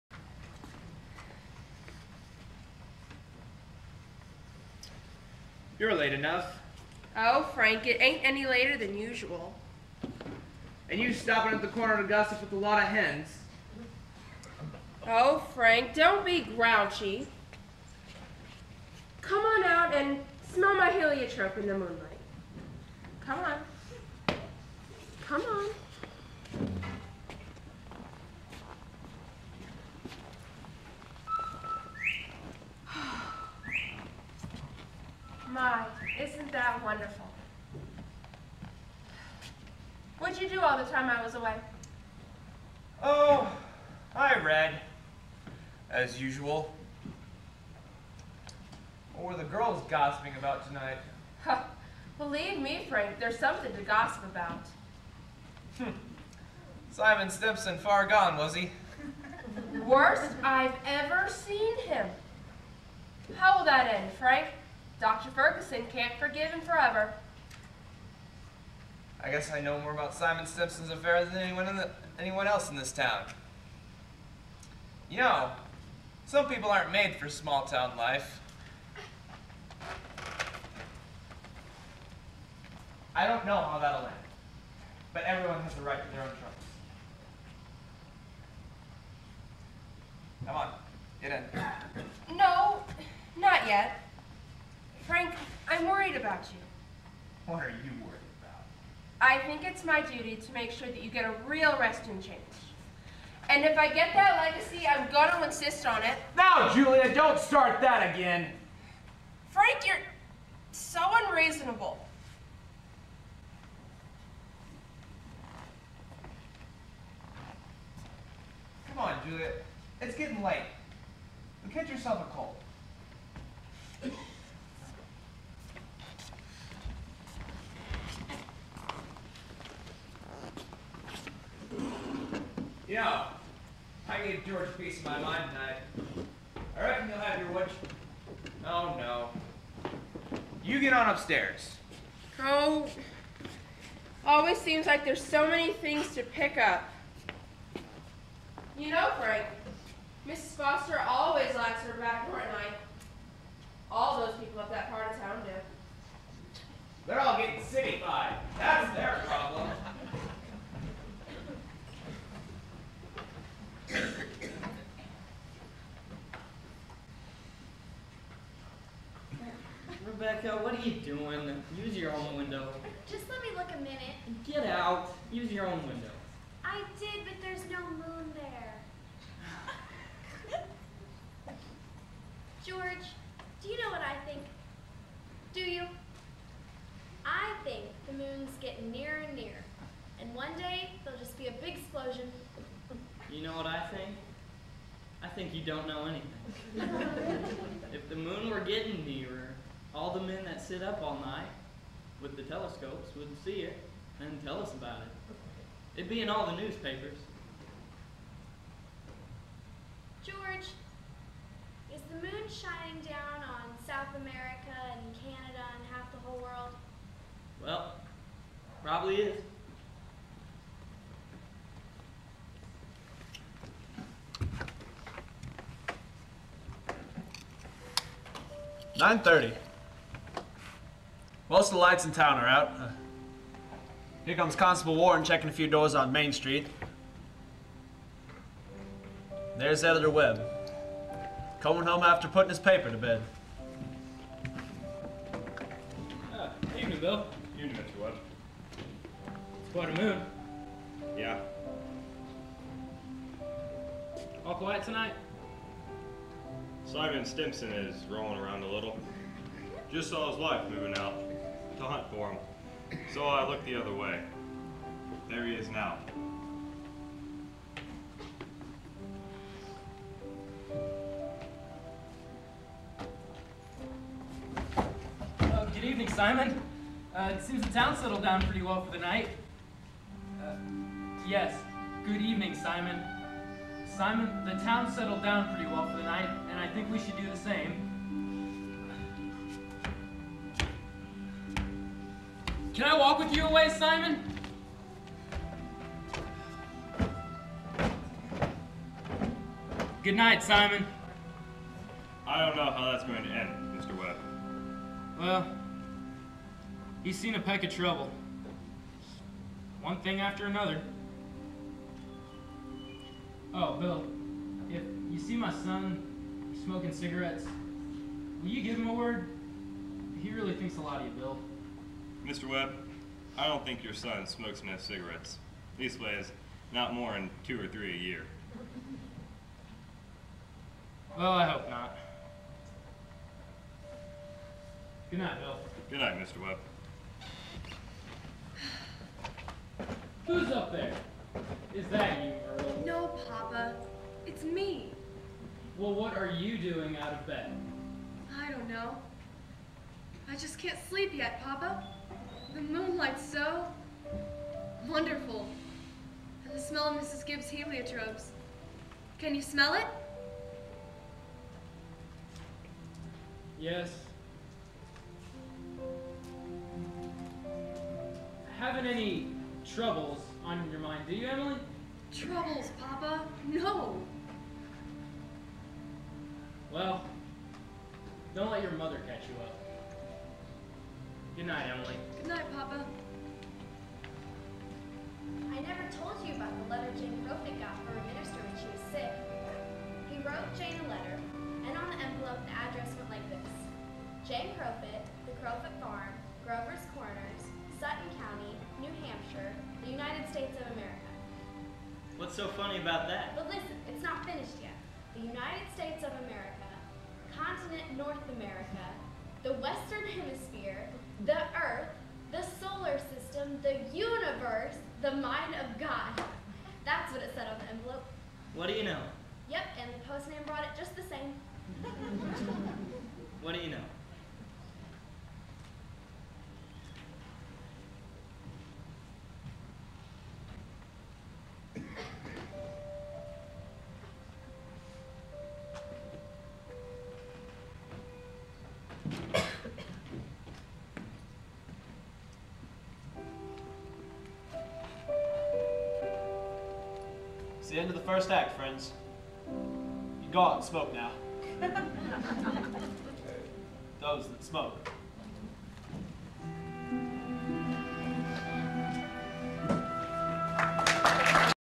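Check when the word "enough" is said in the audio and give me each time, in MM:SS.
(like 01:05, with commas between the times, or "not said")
00:06, 05:24.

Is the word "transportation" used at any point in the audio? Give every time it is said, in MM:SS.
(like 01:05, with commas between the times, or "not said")
not said.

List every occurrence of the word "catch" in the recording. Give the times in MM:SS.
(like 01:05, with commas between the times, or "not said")
02:01, 06:19.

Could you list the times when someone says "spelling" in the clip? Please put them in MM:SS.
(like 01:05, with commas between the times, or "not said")
not said.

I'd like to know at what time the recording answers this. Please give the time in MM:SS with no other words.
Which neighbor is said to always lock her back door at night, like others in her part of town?
02:30.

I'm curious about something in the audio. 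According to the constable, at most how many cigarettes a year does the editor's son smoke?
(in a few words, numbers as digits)
2 or 3.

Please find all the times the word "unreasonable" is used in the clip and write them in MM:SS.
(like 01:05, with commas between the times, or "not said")
01:51.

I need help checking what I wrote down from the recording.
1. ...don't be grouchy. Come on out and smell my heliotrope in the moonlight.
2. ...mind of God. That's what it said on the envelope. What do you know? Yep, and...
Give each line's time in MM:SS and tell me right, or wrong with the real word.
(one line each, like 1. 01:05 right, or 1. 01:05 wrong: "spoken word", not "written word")
1. 00:15 right
2. 06:55 right.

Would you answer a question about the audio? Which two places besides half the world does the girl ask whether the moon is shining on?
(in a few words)
South America and Canada.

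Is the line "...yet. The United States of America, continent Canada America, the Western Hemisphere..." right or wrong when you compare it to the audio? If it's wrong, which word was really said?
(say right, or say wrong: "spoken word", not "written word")
wrong: "North", not "Canada".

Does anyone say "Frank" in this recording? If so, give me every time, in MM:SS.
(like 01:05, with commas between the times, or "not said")
00:07, 00:15, 00:52, 01:04, 01:35, 01:49, 02:29.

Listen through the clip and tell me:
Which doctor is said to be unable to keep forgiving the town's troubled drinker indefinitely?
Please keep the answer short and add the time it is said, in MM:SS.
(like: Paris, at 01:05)
Dr. Ferguson, at 01:05.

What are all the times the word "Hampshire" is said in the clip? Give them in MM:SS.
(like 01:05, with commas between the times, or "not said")
06:38.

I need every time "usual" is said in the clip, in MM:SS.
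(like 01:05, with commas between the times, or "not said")
00:08, 00:46.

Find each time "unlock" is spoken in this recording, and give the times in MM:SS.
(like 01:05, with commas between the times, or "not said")
not said.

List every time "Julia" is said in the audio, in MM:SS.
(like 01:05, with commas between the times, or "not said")
01:46, 01:59.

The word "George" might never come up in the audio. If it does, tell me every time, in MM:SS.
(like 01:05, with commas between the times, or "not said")
02:14, 03:02, 03:30.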